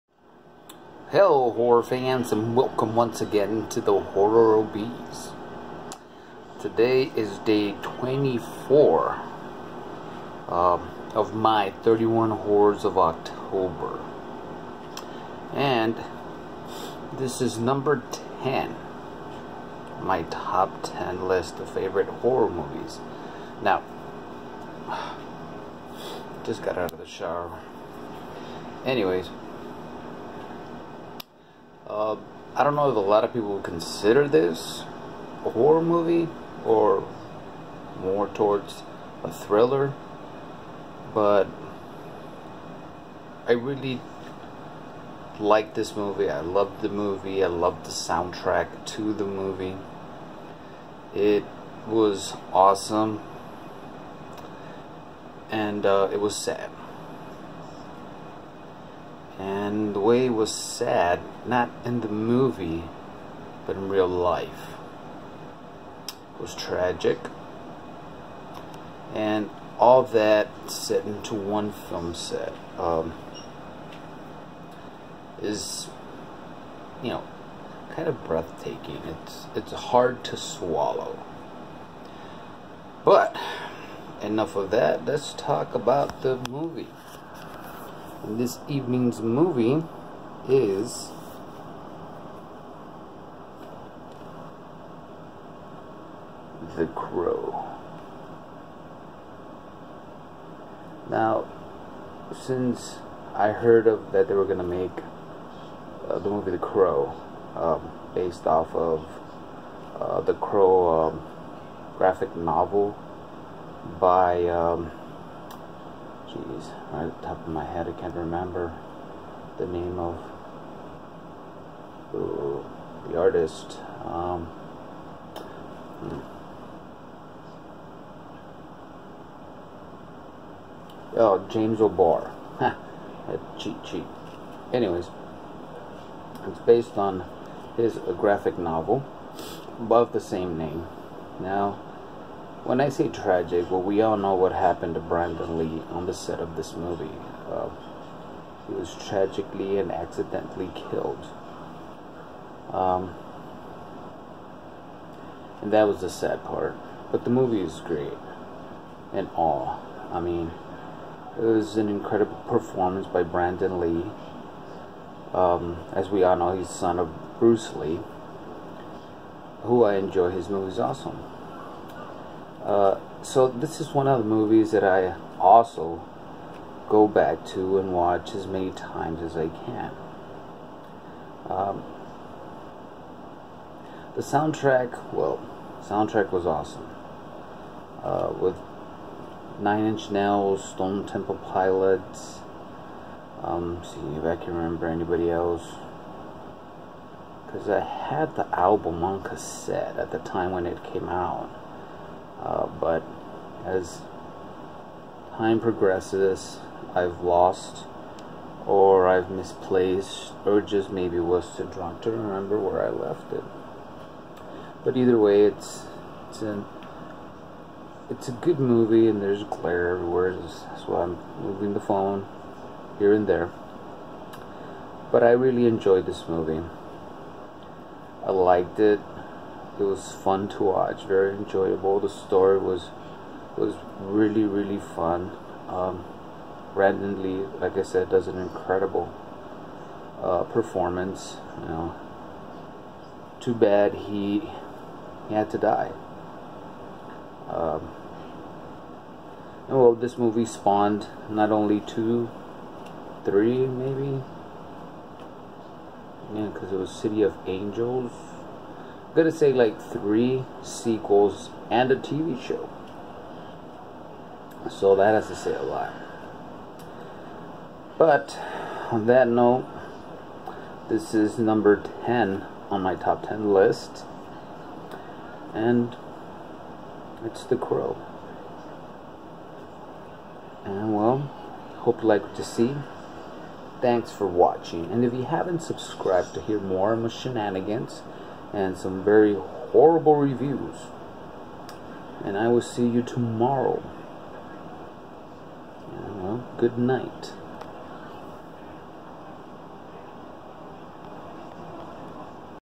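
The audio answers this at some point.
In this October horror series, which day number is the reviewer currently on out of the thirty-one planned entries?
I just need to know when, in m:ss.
0:07.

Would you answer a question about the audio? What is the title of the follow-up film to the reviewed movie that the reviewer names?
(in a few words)
City of Angels.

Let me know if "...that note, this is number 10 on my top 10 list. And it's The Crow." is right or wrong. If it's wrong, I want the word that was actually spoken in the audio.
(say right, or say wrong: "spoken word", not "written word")
right.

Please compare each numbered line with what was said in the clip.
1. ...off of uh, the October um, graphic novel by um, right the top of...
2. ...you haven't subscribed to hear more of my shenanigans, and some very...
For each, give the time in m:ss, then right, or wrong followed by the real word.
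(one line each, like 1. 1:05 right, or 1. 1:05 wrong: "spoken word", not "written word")
1. 1:48 wrong: "Crow", not "October"
2. 4:45 right.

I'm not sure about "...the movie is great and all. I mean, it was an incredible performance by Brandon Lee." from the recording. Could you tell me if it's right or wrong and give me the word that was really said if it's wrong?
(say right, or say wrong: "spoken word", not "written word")
right.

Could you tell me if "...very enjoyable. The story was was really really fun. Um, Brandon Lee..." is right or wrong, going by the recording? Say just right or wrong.
right.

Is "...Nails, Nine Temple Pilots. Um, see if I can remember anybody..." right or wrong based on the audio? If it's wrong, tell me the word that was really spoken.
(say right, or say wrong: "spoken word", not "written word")
wrong: "Stone", not "Nine".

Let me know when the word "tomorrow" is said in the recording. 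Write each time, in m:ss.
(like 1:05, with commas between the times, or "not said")
4:53.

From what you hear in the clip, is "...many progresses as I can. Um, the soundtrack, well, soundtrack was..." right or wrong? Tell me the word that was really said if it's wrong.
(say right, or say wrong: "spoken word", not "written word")
wrong: "times", not "progresses".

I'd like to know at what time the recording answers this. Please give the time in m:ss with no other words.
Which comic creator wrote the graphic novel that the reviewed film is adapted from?
2:11.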